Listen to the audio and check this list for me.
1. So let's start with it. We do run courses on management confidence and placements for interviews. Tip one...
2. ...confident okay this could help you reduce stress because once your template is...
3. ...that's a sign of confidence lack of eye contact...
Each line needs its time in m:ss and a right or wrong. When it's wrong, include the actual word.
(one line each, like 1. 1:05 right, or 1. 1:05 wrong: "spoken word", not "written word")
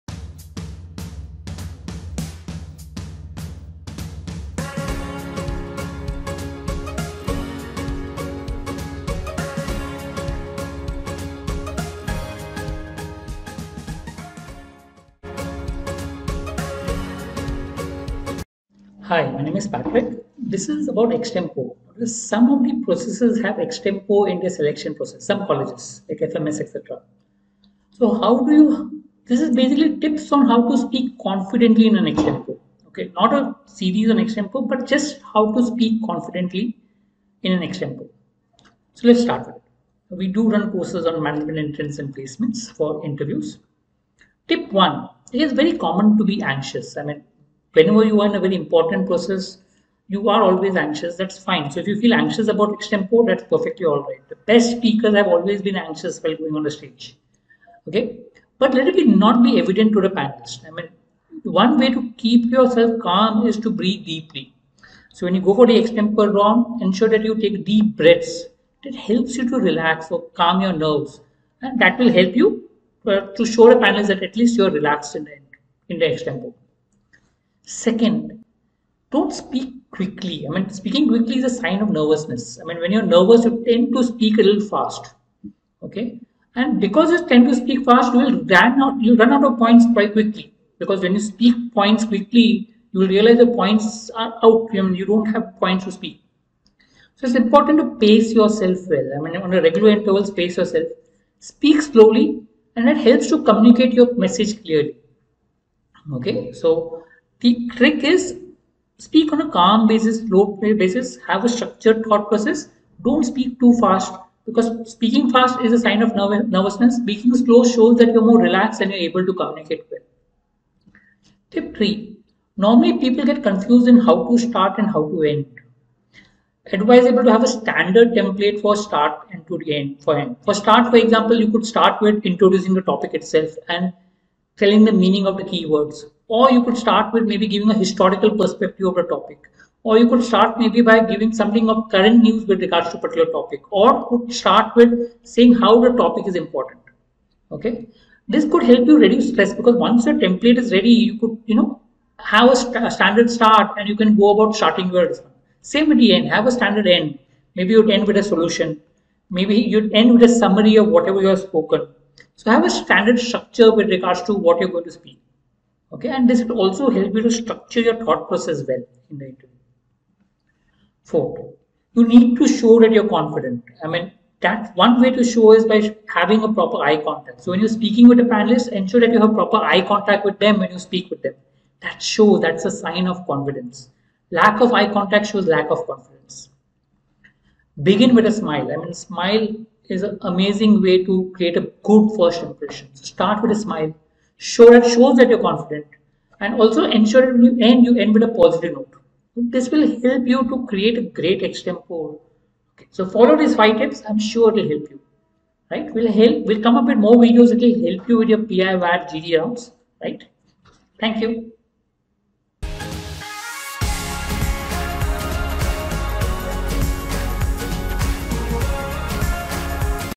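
1. 0:38 wrong: "entrance", not "confidence"
2. 2:26 wrong: "important", not "confident"
3. 3:02 right.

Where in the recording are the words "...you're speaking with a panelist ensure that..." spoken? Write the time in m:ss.
2:57.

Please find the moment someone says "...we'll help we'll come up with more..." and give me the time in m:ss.
3:25.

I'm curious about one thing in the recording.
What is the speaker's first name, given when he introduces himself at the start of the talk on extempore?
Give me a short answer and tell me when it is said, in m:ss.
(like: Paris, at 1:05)
Patrick, at 0:19.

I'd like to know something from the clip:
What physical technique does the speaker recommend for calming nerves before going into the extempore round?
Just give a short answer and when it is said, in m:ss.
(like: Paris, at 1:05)
Breathe deeply, at 1:03.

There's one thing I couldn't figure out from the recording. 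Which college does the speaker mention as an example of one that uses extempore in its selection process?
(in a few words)
FMS.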